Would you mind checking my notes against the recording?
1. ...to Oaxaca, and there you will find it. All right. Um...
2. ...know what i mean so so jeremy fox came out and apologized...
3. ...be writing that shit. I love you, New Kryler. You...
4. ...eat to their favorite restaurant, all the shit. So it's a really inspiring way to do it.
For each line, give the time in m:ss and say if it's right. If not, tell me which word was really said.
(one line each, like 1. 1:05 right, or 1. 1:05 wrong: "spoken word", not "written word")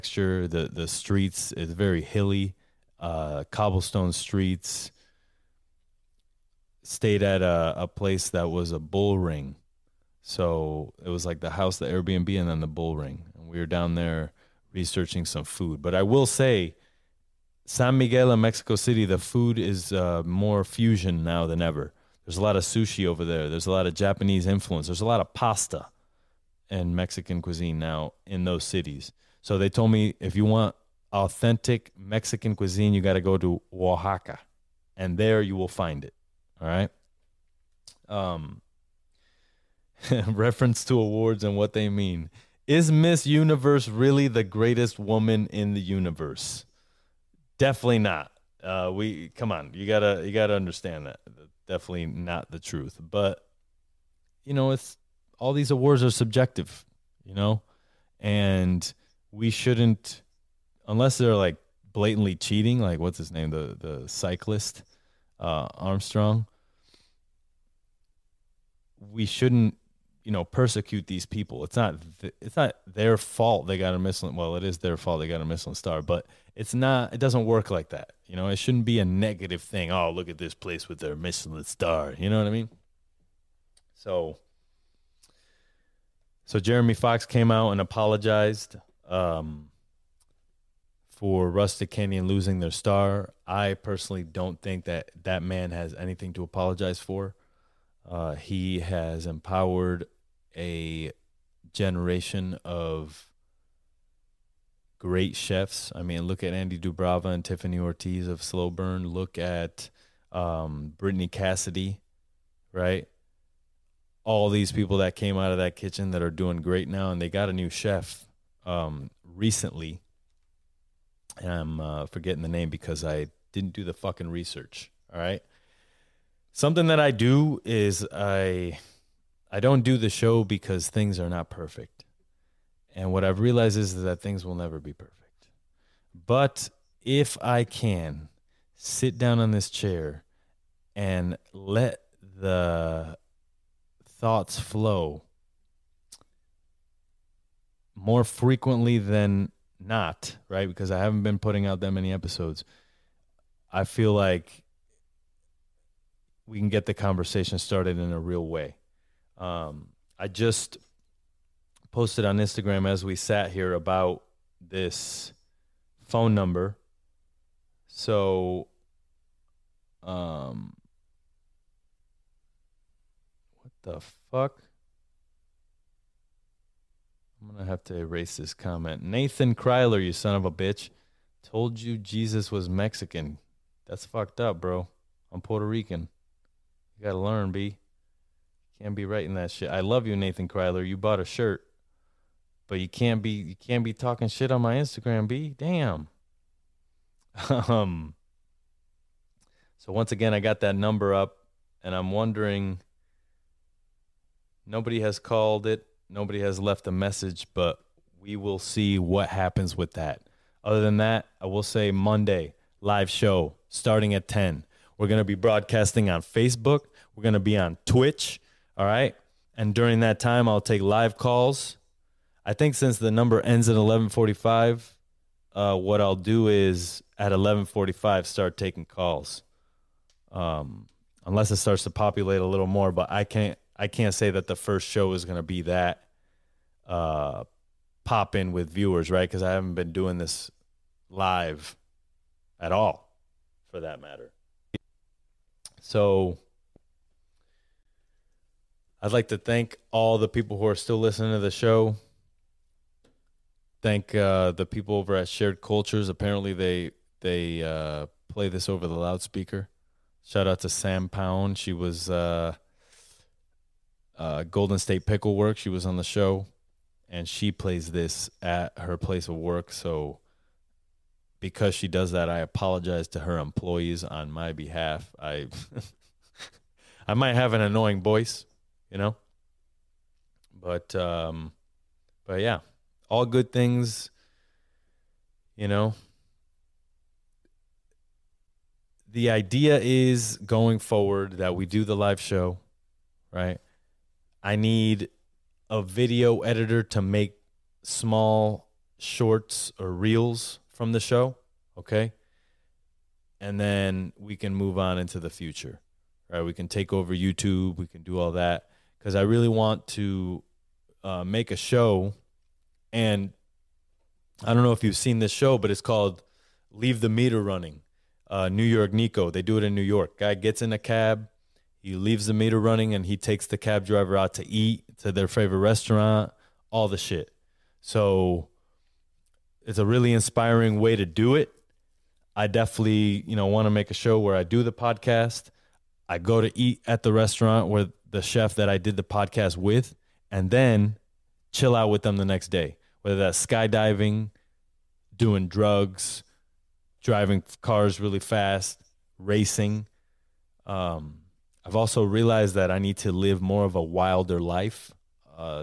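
1. 0:33 right
2. 1:22 right
3. 3:08 wrong: "Nathan", not "New"
4. 5:24 right.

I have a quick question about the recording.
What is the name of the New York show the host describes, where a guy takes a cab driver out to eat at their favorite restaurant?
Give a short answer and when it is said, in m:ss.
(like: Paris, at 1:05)
Leave the Meter Running, at 5:16.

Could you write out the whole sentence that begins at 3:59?
Cause I haven't been doing this live at all for that matter.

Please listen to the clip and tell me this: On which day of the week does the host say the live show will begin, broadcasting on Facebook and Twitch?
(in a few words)
Monday.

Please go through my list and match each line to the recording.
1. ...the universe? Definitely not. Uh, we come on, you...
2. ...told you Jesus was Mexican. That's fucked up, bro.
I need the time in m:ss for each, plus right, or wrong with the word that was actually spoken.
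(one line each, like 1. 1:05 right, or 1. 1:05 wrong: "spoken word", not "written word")
1. 0:45 right
2. 3:01 right.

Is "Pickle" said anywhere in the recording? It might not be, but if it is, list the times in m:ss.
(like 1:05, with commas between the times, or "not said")
4:25.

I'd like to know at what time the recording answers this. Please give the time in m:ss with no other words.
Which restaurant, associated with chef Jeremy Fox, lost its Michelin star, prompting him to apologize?
1:31.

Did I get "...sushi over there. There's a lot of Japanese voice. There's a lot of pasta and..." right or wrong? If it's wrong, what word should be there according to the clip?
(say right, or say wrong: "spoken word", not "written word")
wrong: "influence", not "voice".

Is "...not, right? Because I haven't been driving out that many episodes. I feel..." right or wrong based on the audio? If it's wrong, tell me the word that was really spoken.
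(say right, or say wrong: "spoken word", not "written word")
wrong: "putting", not "driving".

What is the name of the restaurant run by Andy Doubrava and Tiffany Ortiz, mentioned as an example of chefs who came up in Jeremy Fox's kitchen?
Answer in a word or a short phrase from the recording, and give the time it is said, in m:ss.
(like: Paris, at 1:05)
Slow Burn, at 1:48.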